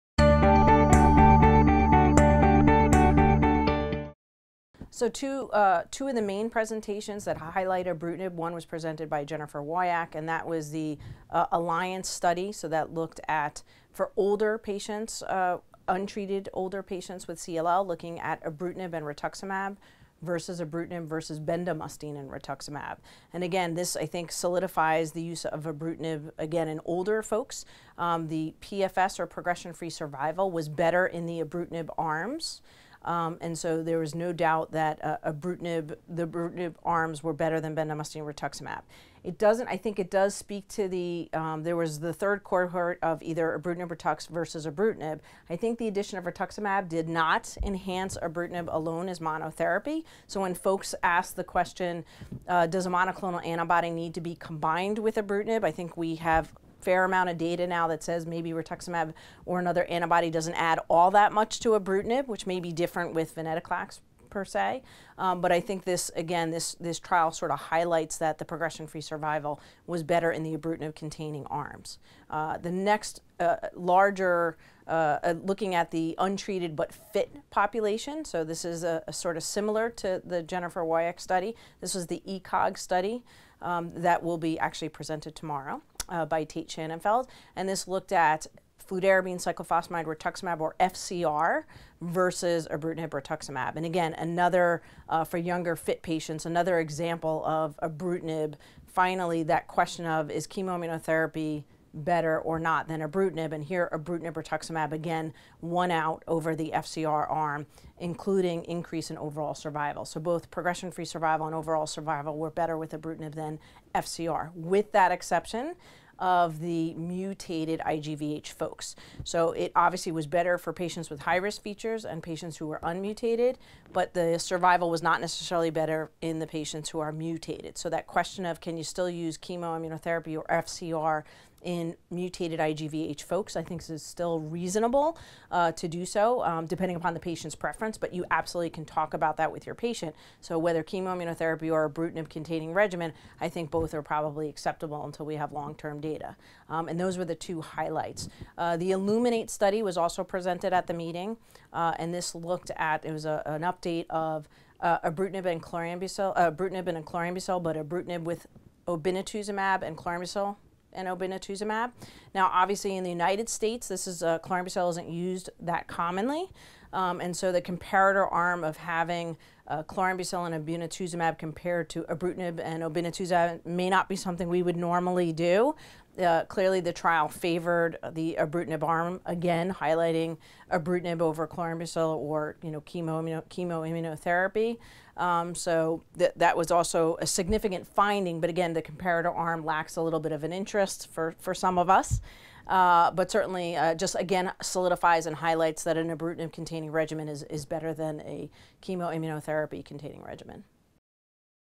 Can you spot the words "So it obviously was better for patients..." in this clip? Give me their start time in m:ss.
1:59.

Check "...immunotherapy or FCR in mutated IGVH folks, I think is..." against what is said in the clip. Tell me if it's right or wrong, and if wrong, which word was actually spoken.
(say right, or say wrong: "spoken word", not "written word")
wrong: "chemoimmunotherapy", not "immunotherapy".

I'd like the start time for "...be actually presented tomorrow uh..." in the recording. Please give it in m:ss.
1:24.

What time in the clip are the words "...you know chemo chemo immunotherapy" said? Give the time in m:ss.
3:02.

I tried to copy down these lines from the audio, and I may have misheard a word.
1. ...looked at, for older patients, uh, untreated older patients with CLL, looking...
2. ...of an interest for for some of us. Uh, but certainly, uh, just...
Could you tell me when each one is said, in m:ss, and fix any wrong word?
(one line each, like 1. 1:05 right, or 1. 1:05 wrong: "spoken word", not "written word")
1. 0:12 right
2. 3:10 right.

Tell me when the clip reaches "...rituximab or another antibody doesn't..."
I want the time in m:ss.
0:58.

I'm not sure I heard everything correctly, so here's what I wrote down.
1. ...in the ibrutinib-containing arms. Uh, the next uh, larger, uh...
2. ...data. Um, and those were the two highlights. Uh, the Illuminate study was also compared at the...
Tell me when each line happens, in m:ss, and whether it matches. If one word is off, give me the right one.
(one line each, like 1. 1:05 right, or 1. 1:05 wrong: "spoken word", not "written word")
1. 1:10 right
2. 2:26 wrong: "presented", not "compared".